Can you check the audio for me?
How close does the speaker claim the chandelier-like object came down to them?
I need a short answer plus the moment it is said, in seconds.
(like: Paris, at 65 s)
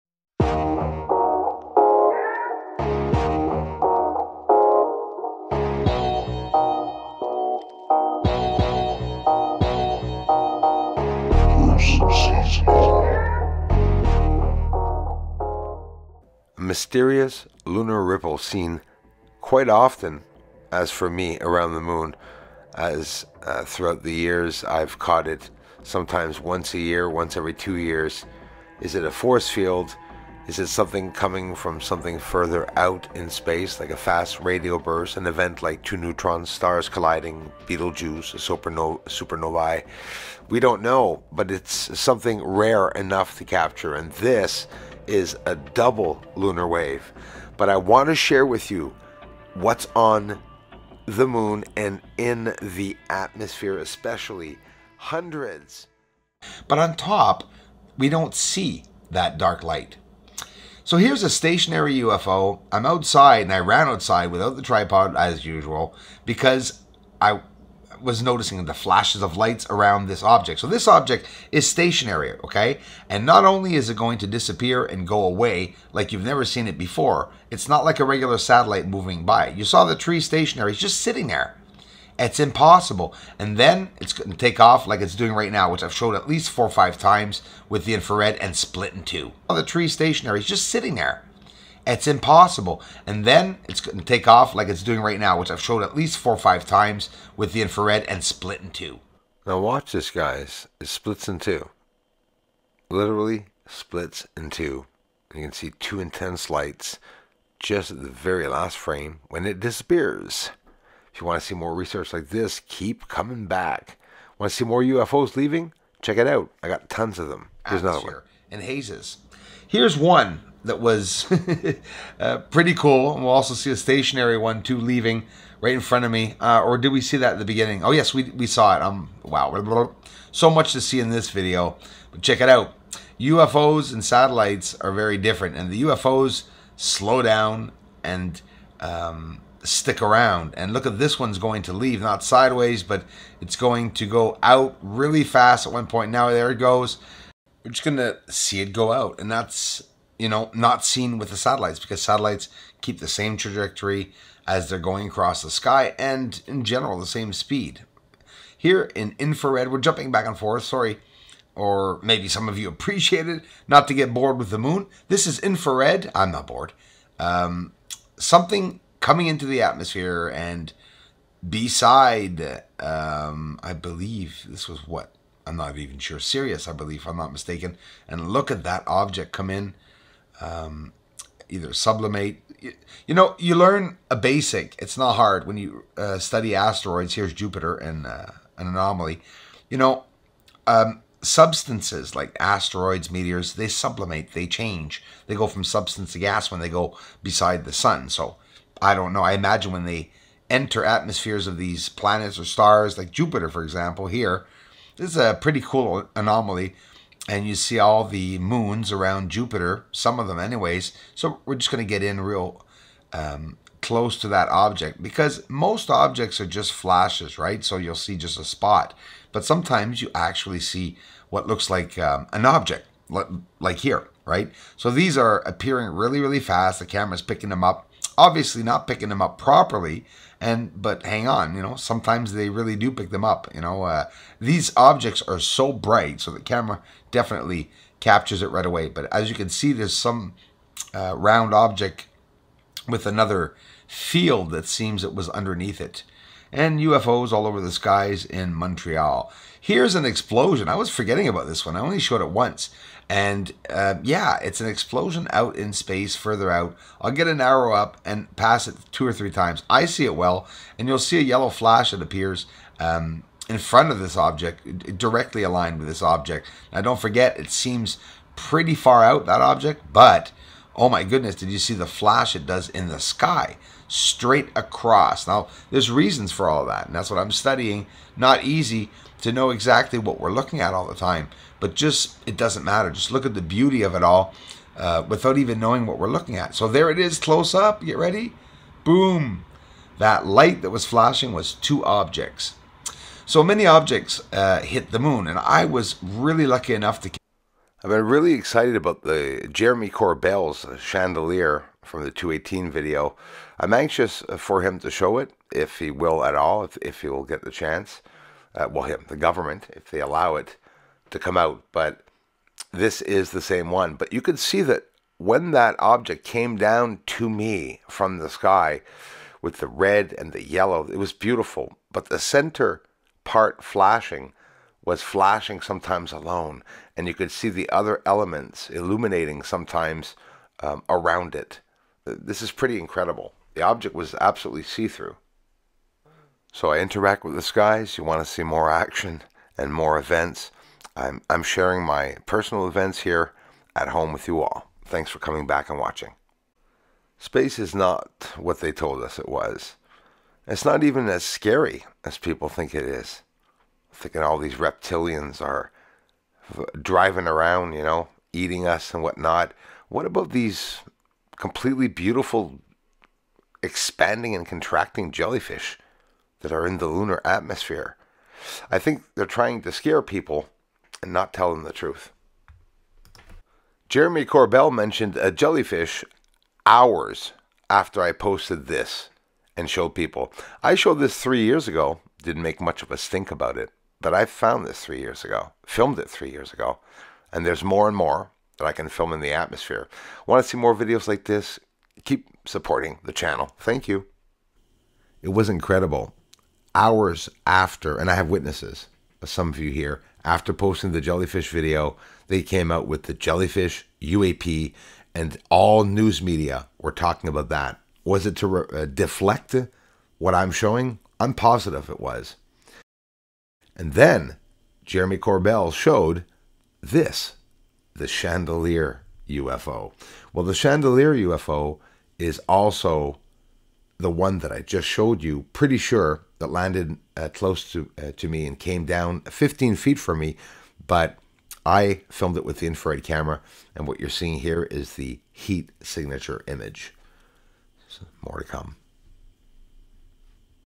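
15 feet, at 429 s.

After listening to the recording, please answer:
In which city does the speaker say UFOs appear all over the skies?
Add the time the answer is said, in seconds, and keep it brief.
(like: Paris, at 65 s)
Montreal, at 248 s.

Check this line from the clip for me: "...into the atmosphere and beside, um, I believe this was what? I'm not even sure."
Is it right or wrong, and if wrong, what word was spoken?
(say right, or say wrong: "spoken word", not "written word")
right.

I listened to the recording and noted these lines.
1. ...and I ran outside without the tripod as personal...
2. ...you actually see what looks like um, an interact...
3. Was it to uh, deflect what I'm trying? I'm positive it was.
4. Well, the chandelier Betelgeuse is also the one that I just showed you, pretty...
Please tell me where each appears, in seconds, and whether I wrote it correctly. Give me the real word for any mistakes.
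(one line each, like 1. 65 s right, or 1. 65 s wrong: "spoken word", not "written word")
1. 63 s wrong: "usual", not "personal"
2. 220 s wrong: "object", not "interact"
3. 408 s wrong: "showing", not "trying"
4. 420 s wrong: "UFO", not "Betelgeuse".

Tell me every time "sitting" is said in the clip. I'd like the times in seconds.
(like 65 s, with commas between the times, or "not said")
81 s, 90 s.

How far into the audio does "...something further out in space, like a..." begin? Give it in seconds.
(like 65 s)
31 s.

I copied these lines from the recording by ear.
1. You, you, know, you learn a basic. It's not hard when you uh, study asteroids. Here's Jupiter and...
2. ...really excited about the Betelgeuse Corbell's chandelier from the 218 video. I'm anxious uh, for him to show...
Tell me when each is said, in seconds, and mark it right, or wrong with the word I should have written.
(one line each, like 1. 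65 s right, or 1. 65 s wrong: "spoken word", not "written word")
1. 182 s right
2. 298 s wrong: "Jeremy", not "Betelgeuse".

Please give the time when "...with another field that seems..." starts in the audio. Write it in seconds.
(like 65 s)
242 s.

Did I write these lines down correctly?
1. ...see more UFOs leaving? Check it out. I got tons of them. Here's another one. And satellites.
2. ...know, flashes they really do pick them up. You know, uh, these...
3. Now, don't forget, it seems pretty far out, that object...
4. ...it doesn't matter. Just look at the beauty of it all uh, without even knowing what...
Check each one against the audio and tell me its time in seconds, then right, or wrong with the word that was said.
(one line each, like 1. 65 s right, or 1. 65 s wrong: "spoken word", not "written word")
1. 114 s wrong: "hazes", not "satellites"
2. 231 s wrong: "sometimes", not "flashes"
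3. 266 s right
4. 282 s right.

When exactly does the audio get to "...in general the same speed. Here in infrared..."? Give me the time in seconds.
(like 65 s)
156 s.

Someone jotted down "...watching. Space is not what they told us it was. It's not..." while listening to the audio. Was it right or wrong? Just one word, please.
right.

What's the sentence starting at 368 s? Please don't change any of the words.
I think they're trying to scare people and not tell them the truth.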